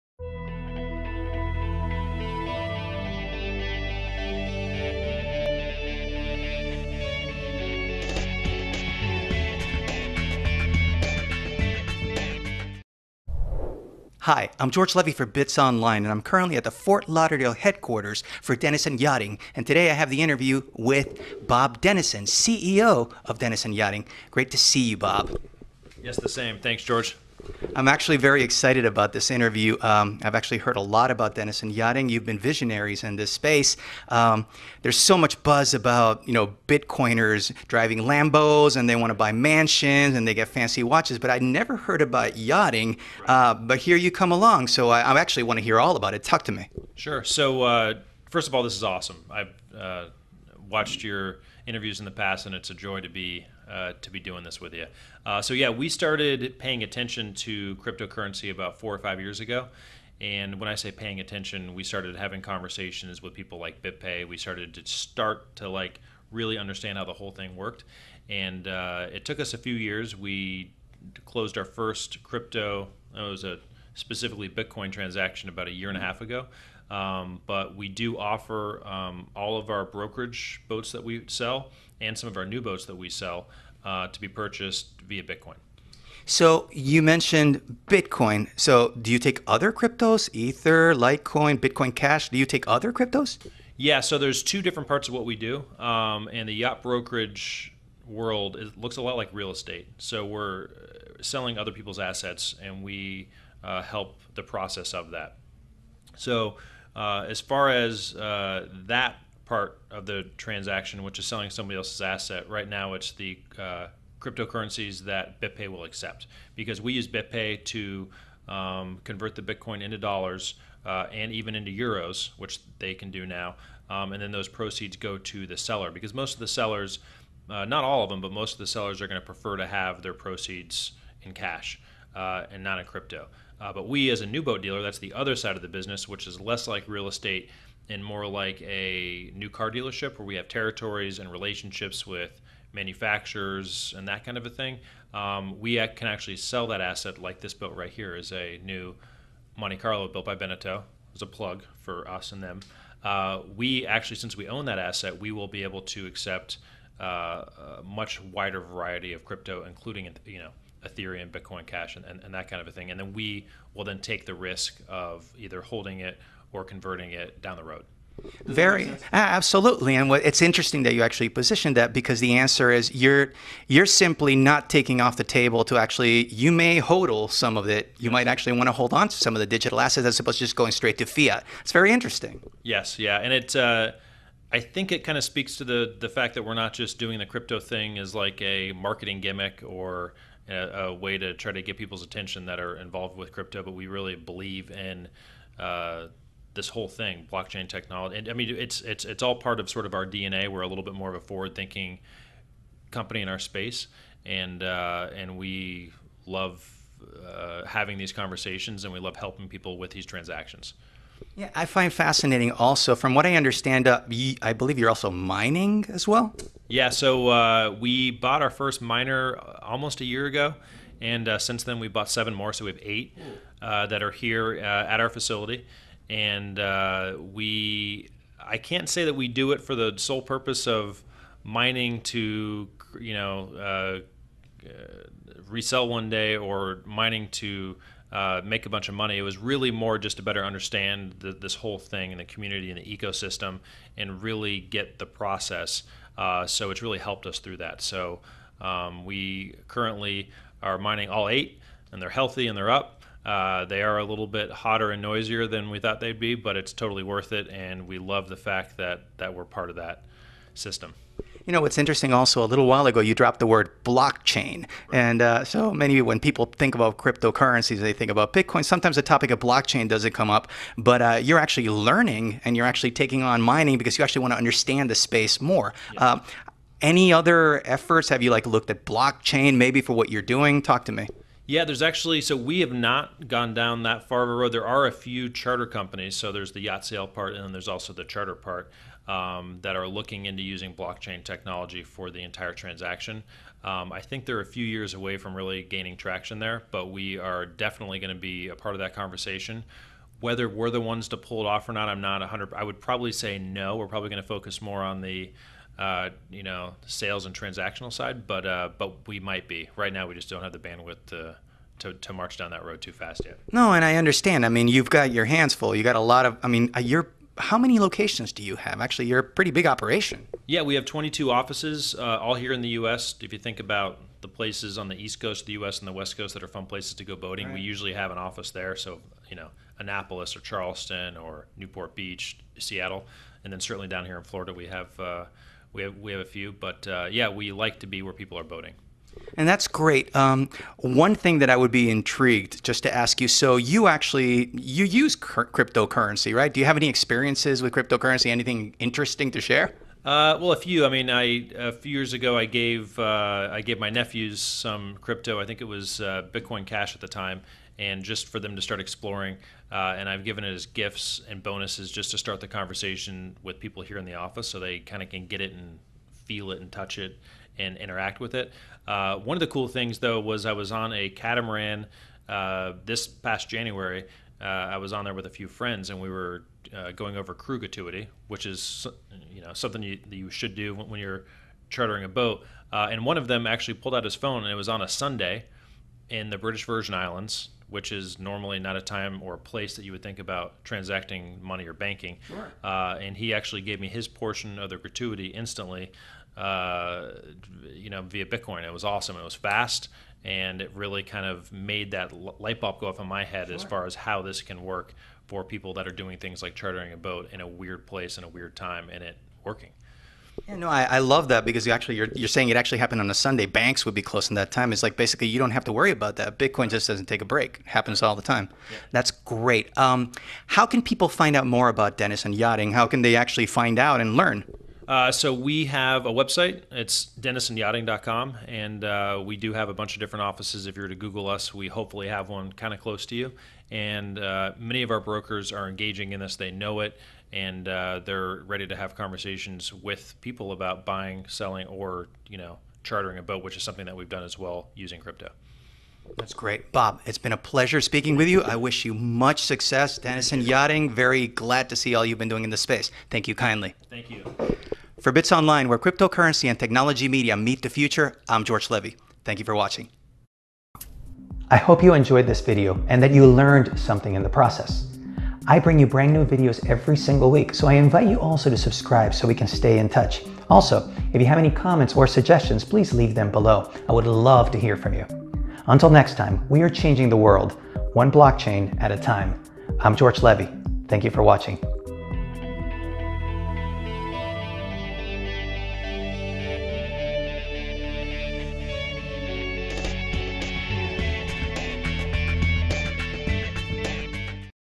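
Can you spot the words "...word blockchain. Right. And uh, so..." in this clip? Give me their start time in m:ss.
4:23.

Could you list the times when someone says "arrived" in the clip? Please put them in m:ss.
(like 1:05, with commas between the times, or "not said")
not said.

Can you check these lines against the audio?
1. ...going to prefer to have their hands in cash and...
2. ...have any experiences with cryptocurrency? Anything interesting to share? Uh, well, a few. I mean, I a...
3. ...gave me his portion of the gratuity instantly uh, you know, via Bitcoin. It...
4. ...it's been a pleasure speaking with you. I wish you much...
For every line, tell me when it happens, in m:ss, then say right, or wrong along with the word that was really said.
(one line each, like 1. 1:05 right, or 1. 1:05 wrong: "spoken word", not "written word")
1. 2:09 wrong: "proceeds", not "hands"
2. 5:46 right
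3. 6:33 right
4. 7:27 right.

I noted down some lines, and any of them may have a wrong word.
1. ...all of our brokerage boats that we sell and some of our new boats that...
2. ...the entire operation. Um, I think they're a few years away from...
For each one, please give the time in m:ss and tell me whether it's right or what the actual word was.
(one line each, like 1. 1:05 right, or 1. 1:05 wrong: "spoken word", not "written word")
1. 1:19 right
2. 4:52 wrong: "transaction", not "operation".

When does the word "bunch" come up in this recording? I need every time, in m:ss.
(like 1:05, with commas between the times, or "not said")
3:58, 7:09.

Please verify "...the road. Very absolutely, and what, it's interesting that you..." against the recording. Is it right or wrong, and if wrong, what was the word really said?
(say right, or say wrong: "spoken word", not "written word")
right.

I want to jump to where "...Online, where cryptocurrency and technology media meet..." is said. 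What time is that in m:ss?
7:35.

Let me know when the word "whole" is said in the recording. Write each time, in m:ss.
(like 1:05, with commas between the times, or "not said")
1:07, 3:16, 4:01.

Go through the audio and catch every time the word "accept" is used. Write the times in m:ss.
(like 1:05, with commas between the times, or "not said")
1:55, 2:36.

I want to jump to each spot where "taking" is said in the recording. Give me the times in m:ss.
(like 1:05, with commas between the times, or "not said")
2:54, 4:32.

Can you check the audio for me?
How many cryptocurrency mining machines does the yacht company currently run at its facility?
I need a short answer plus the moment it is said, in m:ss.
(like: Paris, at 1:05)
8, at 3:42.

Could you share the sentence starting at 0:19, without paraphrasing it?
And today I have the interview with Bob Denison, CEO of Denison Yachting.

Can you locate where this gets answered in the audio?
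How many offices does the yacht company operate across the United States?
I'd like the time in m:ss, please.
5:20.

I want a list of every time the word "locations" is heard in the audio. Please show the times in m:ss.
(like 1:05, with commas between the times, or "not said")
5:17.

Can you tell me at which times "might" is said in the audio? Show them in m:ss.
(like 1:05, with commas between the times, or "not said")
2:58, 5:09.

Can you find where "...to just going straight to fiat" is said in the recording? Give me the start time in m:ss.
3:00.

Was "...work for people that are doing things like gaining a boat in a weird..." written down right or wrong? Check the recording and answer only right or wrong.
wrong.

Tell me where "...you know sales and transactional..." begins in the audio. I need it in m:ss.
5:06.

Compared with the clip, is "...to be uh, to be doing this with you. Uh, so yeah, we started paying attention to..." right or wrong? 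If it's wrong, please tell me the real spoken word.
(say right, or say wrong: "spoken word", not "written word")
right.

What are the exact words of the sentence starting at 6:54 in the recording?
It's like basically you don't have to worry about that.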